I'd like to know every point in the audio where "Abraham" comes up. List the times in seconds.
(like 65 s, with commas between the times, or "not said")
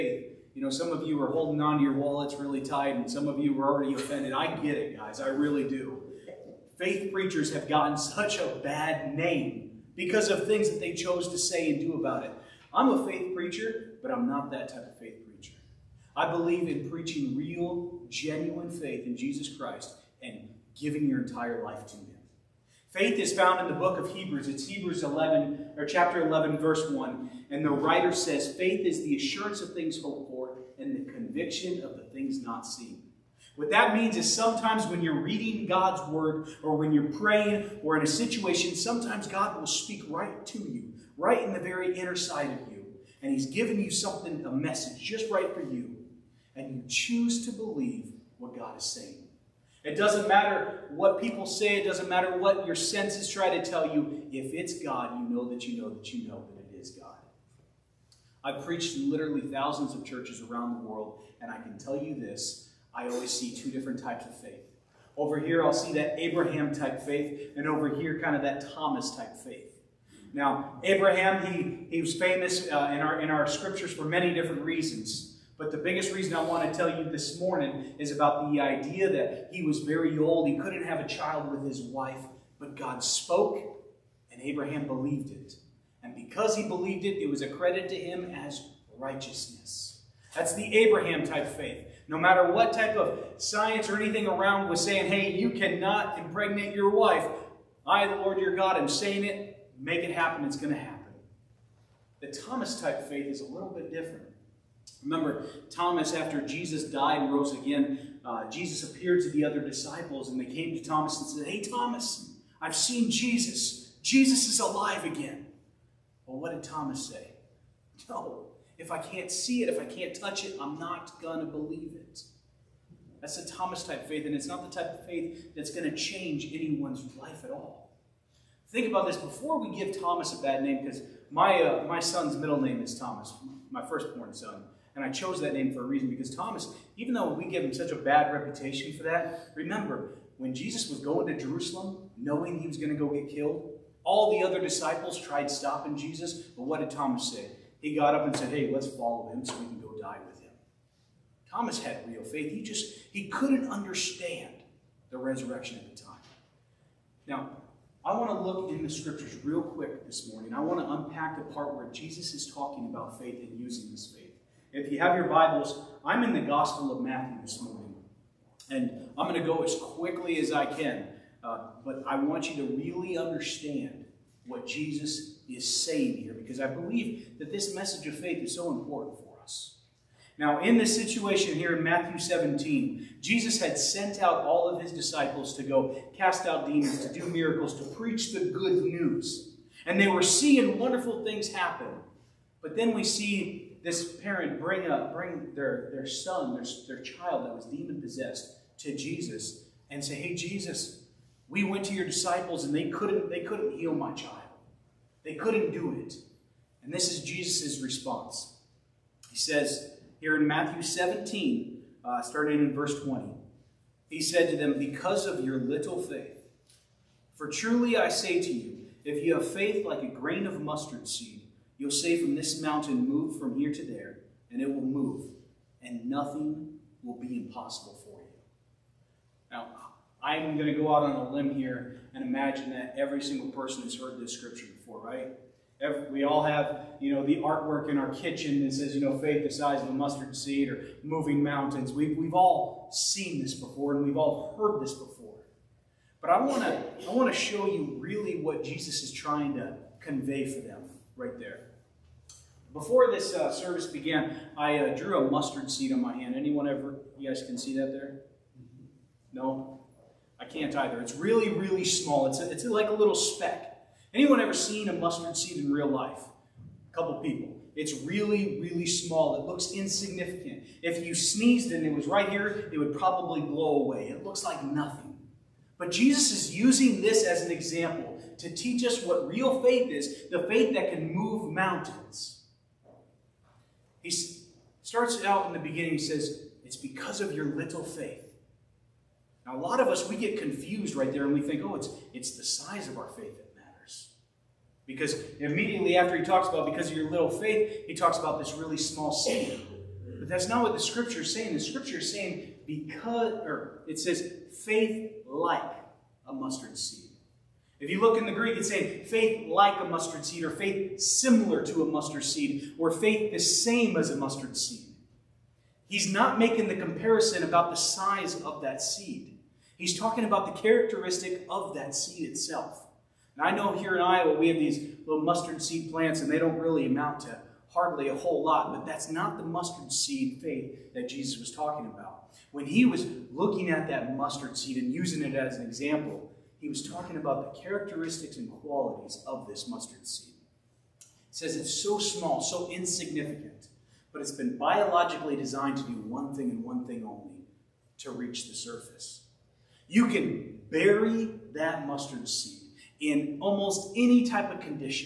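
66 s, 70 s, 84 s, 90 s.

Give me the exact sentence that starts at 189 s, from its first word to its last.
And they were seeing wonderful things happen.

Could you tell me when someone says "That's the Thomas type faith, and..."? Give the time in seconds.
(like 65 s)
123 s.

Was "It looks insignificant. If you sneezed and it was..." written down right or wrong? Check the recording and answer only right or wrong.
right.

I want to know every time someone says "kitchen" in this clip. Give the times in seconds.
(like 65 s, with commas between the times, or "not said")
238 s.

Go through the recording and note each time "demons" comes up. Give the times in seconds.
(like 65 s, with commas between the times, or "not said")
186 s, 197 s.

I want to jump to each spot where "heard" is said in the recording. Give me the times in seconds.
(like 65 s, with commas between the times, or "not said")
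233 s, 244 s.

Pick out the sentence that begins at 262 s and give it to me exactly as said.
It's, a, it's like a little speck.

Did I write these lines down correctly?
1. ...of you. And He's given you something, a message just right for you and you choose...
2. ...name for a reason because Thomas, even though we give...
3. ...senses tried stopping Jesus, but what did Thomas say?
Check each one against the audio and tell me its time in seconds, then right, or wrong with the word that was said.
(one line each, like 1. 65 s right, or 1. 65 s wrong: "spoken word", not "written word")
1. 42 s right
2. 135 s right
3. 144 s wrong: "disciples", not "senses".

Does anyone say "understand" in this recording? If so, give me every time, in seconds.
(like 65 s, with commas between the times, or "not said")
153 s, 173 s.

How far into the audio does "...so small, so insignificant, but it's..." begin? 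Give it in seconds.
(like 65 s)
341 s.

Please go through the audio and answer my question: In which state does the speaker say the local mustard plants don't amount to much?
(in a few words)
Iowa.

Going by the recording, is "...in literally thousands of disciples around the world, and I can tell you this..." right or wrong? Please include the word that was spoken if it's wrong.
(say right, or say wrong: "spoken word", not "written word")
wrong: "churches", not "disciples".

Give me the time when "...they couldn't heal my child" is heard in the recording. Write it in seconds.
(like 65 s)
203 s.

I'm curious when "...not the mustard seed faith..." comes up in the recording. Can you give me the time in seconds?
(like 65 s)
329 s.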